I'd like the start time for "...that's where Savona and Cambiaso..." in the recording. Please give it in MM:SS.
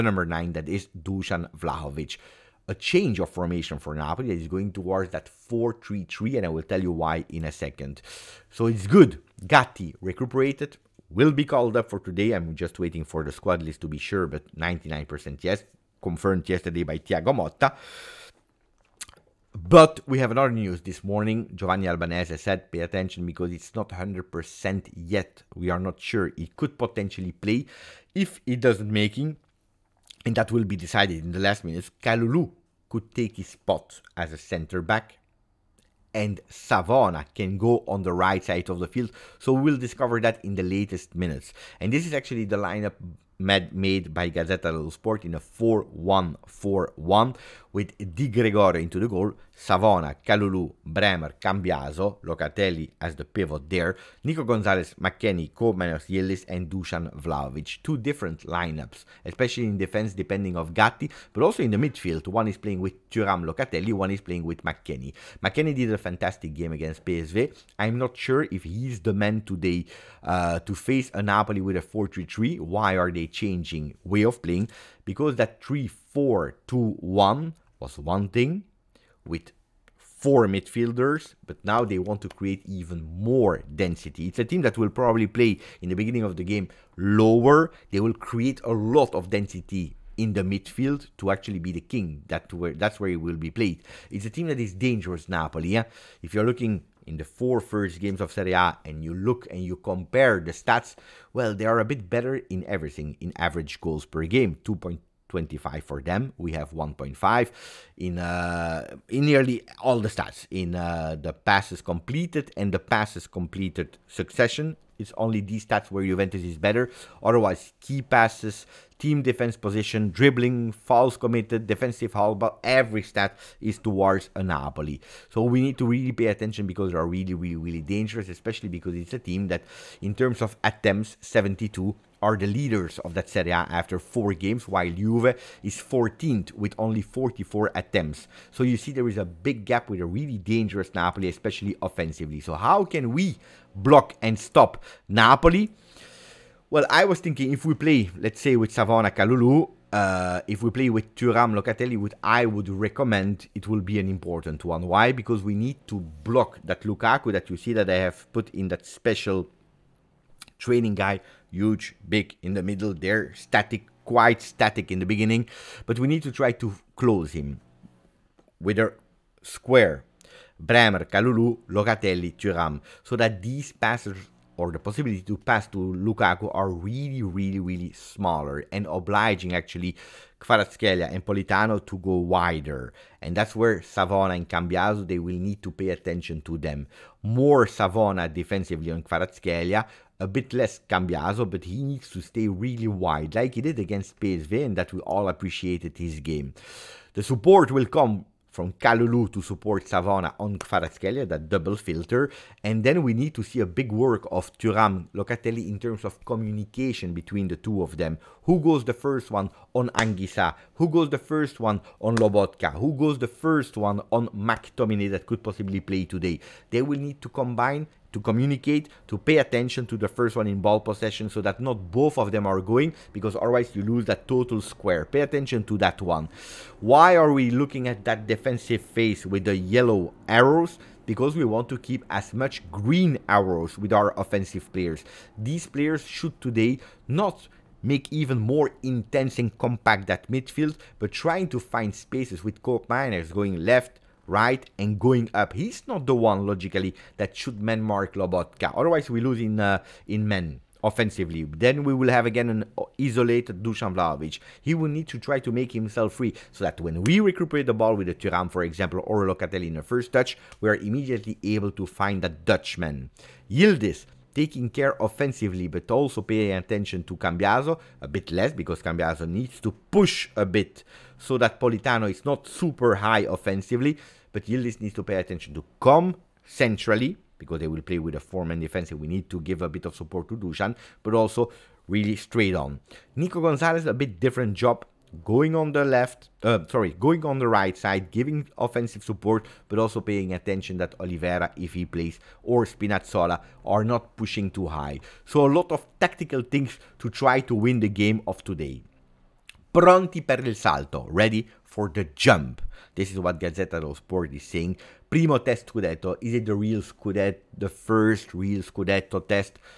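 03:03.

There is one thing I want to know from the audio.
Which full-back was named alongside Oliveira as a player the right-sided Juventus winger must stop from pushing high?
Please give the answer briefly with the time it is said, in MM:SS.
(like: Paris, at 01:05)
Spinazzola, at 04:52.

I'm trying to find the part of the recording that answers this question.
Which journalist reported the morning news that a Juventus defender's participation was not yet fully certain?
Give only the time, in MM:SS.
00:21.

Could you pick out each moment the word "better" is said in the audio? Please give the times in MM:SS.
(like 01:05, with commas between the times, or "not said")
01:42, 01:56.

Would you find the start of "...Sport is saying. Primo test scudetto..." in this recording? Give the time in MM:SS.
05:03.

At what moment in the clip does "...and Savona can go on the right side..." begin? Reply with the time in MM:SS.
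00:36.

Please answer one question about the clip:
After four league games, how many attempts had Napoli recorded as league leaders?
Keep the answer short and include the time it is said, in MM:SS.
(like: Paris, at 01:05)
72, at 02:11.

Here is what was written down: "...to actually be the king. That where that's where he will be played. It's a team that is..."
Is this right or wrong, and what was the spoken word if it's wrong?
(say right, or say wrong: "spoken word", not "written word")
right.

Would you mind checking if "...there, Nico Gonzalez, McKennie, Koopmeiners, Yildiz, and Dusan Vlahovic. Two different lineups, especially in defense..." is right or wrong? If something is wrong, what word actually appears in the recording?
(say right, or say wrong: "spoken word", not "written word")
right.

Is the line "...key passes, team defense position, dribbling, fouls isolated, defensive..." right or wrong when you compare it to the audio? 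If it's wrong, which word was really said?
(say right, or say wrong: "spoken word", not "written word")
wrong: "committed", not "isolated".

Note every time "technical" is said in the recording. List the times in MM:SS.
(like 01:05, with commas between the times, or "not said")
not said.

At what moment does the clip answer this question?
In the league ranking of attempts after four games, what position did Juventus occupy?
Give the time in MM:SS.
02:15.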